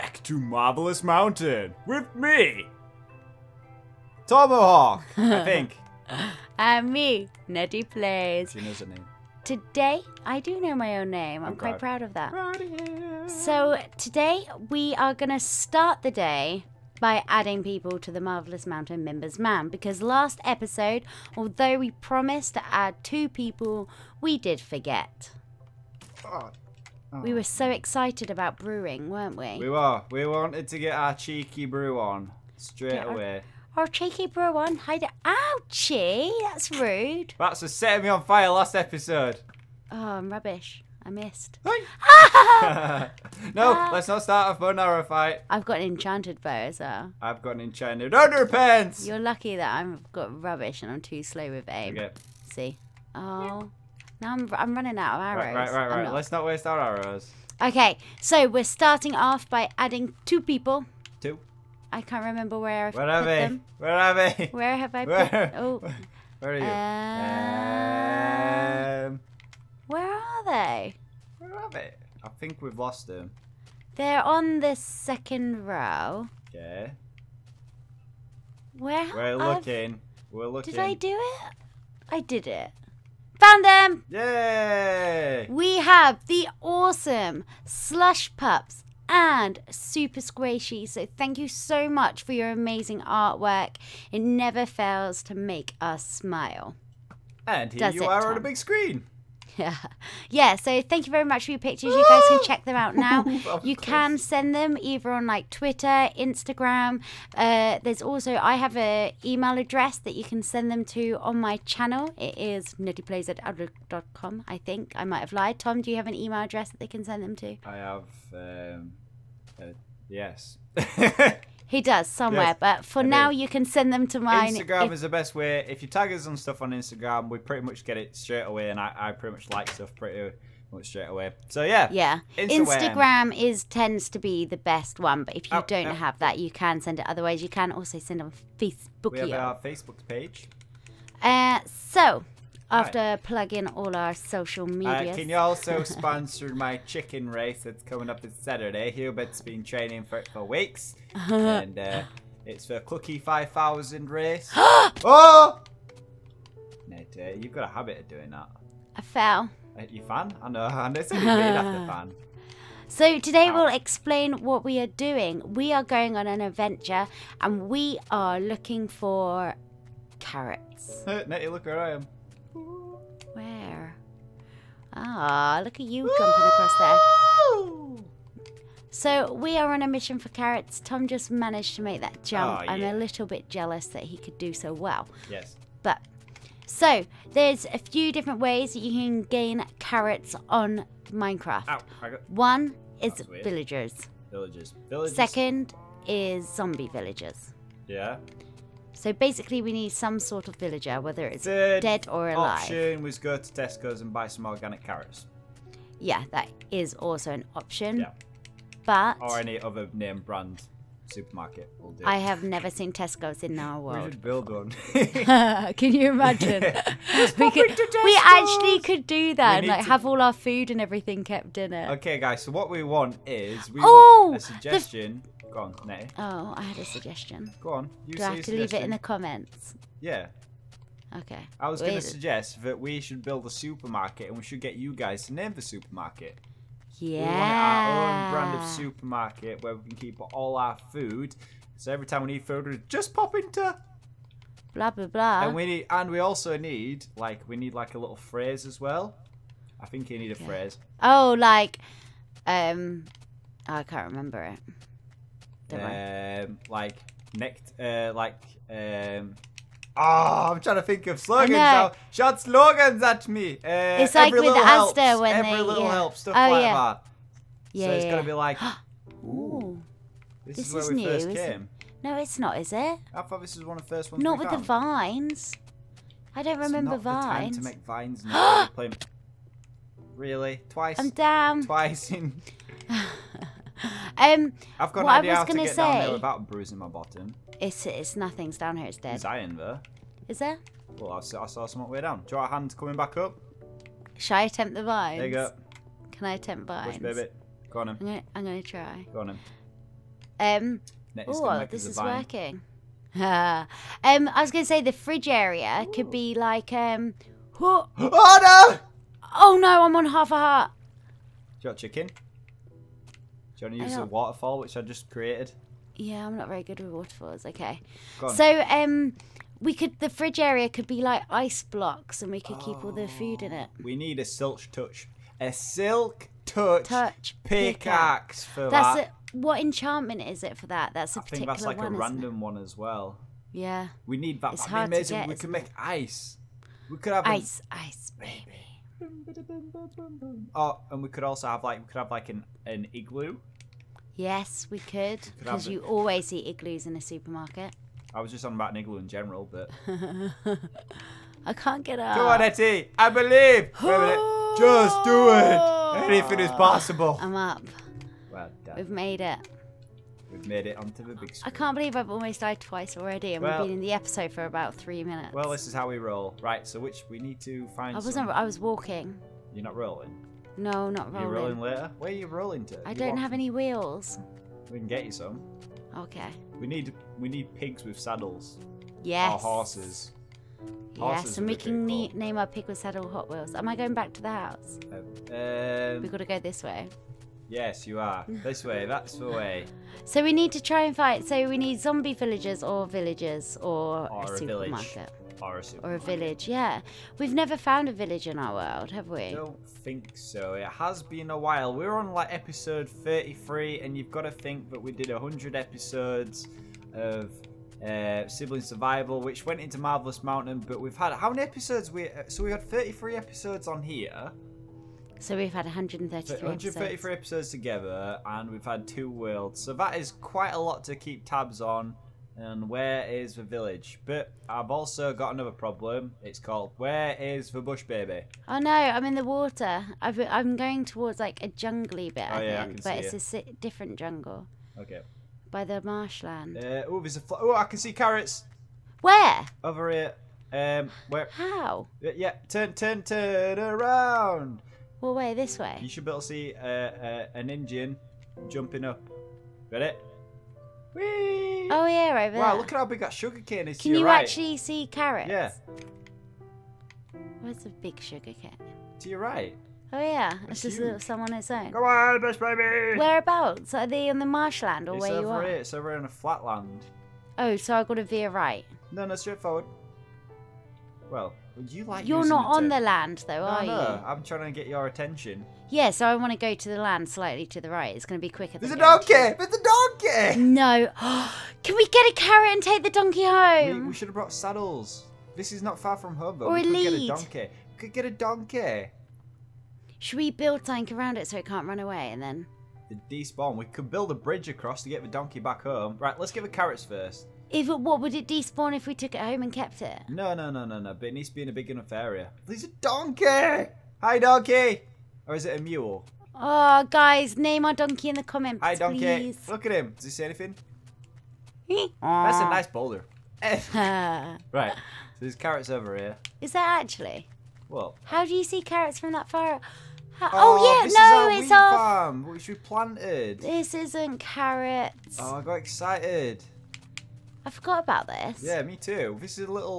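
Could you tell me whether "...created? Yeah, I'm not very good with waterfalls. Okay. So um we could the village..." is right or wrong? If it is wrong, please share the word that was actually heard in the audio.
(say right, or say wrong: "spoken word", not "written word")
wrong: "fridge", not "village".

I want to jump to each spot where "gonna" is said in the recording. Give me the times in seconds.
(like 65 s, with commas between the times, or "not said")
298 s, 304 s.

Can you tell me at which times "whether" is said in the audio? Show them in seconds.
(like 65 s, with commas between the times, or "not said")
201 s.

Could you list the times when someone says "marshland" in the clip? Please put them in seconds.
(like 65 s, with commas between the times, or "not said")
435 s, 464 s.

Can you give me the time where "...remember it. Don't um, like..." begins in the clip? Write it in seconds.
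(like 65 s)
254 s.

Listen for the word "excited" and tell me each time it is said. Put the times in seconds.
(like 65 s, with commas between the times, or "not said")
27 s, 525 s.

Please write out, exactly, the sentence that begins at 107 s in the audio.
Uh, there's also I have a email address that you can send them to on my channel.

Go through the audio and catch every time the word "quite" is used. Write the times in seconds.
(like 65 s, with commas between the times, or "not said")
11 s, 420 s.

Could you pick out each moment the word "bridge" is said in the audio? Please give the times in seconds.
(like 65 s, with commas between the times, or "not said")
494 s.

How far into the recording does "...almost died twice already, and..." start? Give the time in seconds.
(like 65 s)
362 s.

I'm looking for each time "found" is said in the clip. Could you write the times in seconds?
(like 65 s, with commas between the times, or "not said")
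83 s, 274 s, 397 s.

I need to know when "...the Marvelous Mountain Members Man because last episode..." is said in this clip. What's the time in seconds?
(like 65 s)
18 s.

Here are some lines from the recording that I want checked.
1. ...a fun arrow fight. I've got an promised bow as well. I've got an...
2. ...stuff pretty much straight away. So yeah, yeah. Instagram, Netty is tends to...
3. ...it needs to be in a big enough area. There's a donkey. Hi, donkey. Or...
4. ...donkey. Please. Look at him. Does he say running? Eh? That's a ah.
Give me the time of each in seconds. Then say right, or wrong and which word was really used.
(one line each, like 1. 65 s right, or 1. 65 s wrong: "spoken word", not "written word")
1. 44 s wrong: "enchanted", not "promised"
2. 129 s wrong: "Instagram", not "Netty"
3. 501 s right
4. 508 s wrong: "anything", not "running".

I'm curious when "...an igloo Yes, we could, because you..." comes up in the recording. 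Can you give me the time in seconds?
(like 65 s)
342 s.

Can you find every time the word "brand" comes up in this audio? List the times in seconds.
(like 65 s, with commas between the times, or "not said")
210 s, 238 s.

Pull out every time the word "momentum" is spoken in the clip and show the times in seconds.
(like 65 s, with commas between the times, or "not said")
not said.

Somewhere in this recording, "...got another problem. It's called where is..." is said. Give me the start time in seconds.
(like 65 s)
425 s.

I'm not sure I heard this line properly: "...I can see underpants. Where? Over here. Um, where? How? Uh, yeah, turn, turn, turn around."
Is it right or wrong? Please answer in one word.
wrong.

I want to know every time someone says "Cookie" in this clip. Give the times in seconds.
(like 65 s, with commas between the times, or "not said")
152 s.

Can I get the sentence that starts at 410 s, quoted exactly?
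But we've had how many episodes?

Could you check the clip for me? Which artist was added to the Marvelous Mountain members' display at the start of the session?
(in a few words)
Slush Pups.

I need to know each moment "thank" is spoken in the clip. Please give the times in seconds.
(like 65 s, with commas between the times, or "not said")
91 s, 100 s.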